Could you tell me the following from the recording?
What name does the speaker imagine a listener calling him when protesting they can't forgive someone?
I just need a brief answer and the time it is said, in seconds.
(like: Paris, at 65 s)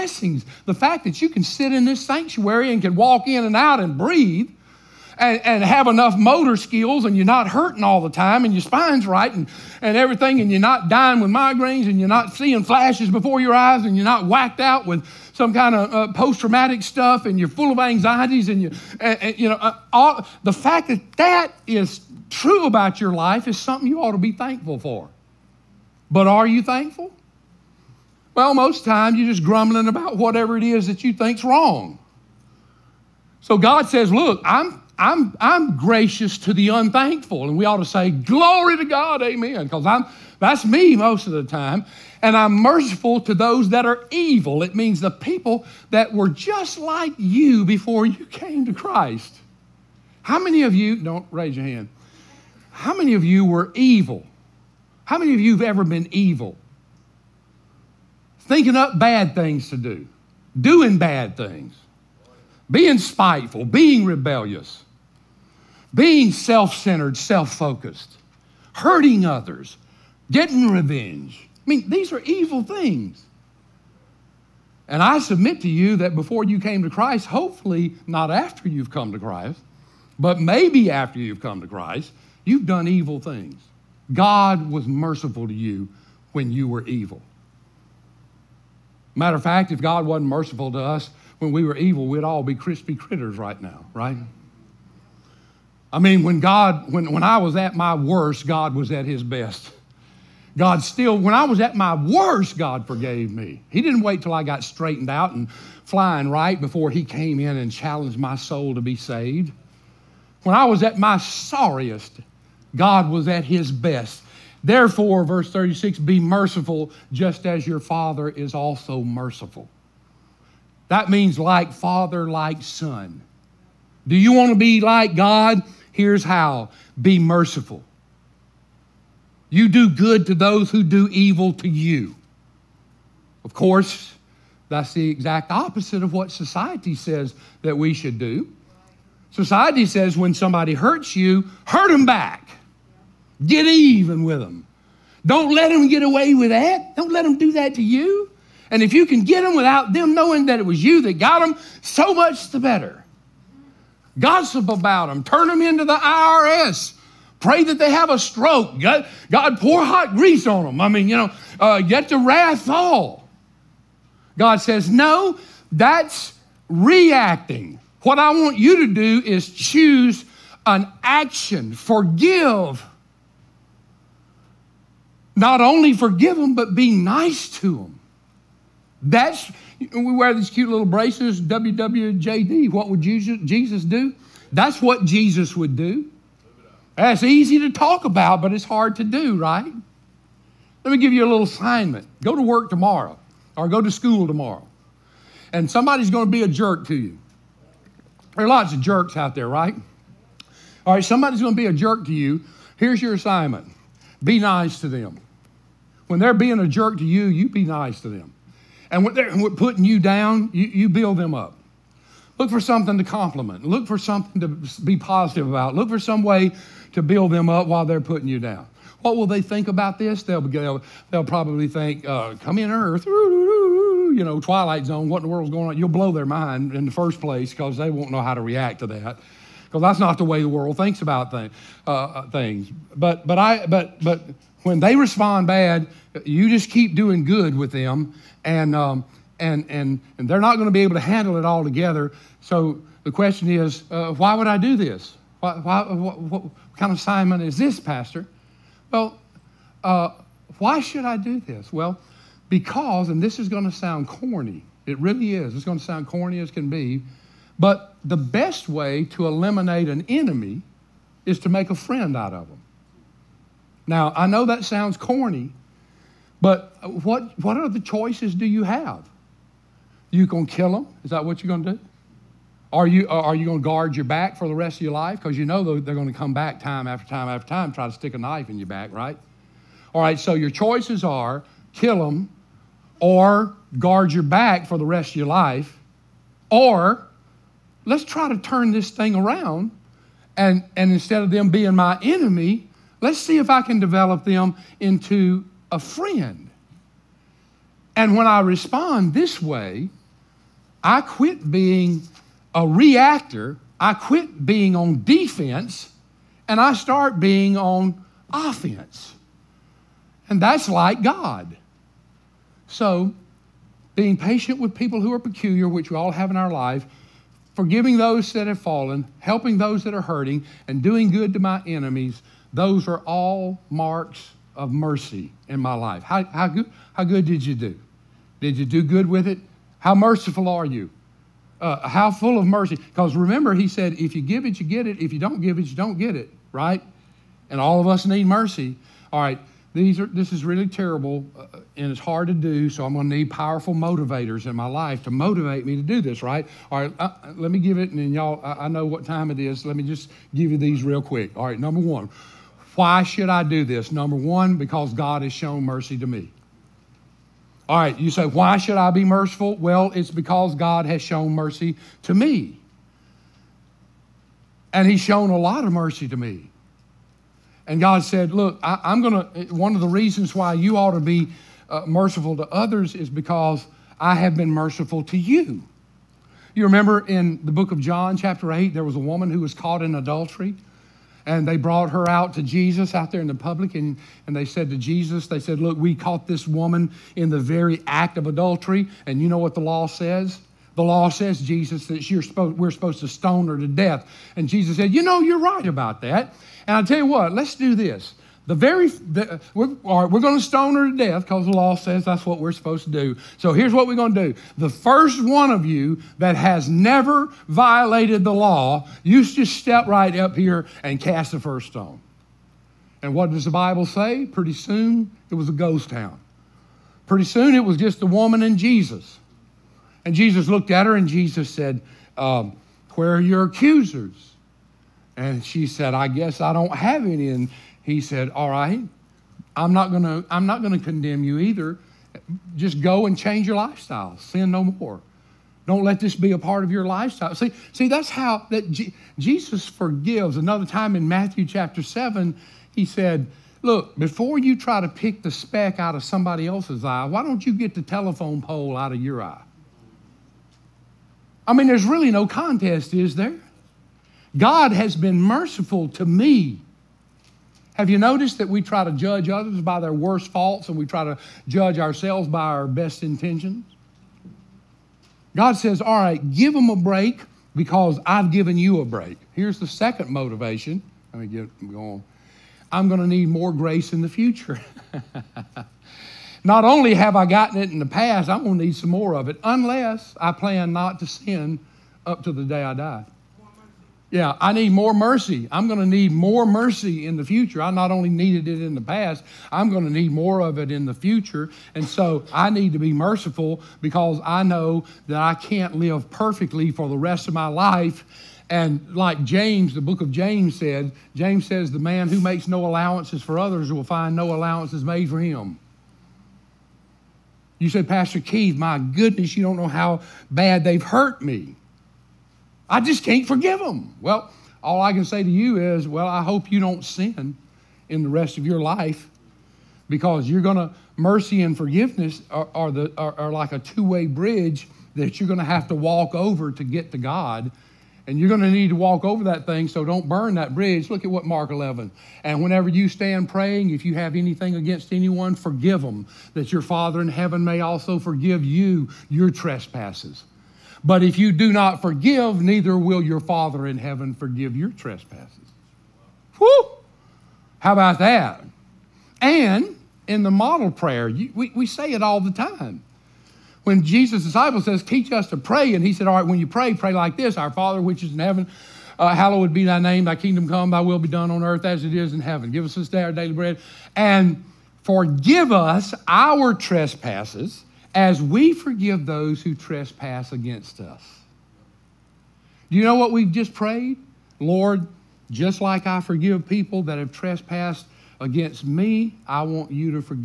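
Pastor Keith, at 507 s.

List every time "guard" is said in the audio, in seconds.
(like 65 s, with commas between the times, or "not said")
273 s, 283 s.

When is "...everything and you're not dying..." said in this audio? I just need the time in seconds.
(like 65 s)
9 s.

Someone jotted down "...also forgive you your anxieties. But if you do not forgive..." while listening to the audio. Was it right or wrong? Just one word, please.
wrong.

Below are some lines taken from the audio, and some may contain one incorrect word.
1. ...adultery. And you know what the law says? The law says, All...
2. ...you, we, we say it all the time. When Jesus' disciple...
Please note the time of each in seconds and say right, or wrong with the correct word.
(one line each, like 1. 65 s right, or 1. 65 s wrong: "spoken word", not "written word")
1. 388 s wrong: "Jesus", not "All"
2. 551 s right.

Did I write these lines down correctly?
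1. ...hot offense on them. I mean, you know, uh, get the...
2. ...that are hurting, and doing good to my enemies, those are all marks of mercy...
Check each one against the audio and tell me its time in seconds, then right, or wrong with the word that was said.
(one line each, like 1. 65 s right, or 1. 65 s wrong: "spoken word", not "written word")
1. 159 s wrong: "grease", not "offense"
2. 319 s right.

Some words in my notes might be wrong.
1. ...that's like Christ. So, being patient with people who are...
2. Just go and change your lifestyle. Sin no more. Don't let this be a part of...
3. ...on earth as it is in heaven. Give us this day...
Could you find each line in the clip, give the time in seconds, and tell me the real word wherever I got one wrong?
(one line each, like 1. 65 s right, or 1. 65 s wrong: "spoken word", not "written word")
1. 310 s wrong: "God", not "Christ"
2. 432 s right
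3. 561 s right.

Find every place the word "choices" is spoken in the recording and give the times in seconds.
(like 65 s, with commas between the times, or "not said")
267 s, 280 s.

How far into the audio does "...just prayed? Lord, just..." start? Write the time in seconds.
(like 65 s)
573 s.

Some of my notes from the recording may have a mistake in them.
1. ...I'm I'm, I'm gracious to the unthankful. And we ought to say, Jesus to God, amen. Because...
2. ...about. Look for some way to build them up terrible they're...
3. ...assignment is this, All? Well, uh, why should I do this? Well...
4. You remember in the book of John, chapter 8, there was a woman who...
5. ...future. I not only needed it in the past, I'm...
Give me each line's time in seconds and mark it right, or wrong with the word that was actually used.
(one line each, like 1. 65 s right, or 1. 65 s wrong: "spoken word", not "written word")
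1. 34 s wrong: "Glory", not "Jesus"
2. 215 s wrong: "while", not "terrible"
3. 246 s wrong: "Pastor", not "All"
4. 376 s right
5. 487 s right.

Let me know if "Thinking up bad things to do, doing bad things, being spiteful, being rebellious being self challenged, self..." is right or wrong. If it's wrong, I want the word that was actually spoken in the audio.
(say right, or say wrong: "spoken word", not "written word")
wrong: "centered", not "challenged".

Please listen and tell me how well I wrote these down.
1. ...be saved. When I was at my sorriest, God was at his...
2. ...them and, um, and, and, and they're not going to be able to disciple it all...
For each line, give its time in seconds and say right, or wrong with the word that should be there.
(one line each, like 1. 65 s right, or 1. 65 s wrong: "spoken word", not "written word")
1. 108 s right
2. 237 s wrong: "handle", not "disciple".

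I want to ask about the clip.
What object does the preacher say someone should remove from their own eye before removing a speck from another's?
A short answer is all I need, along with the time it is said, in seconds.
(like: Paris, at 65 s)
telephone pole, at 447 s.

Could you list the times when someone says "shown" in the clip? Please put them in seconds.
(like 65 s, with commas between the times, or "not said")
355 s, 361 s, 365 s.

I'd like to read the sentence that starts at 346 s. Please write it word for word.
All right, uh, let me give it, and then y'all, I, I know what time it is.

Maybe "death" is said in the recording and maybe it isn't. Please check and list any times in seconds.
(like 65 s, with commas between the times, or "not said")
393 s, 400 s.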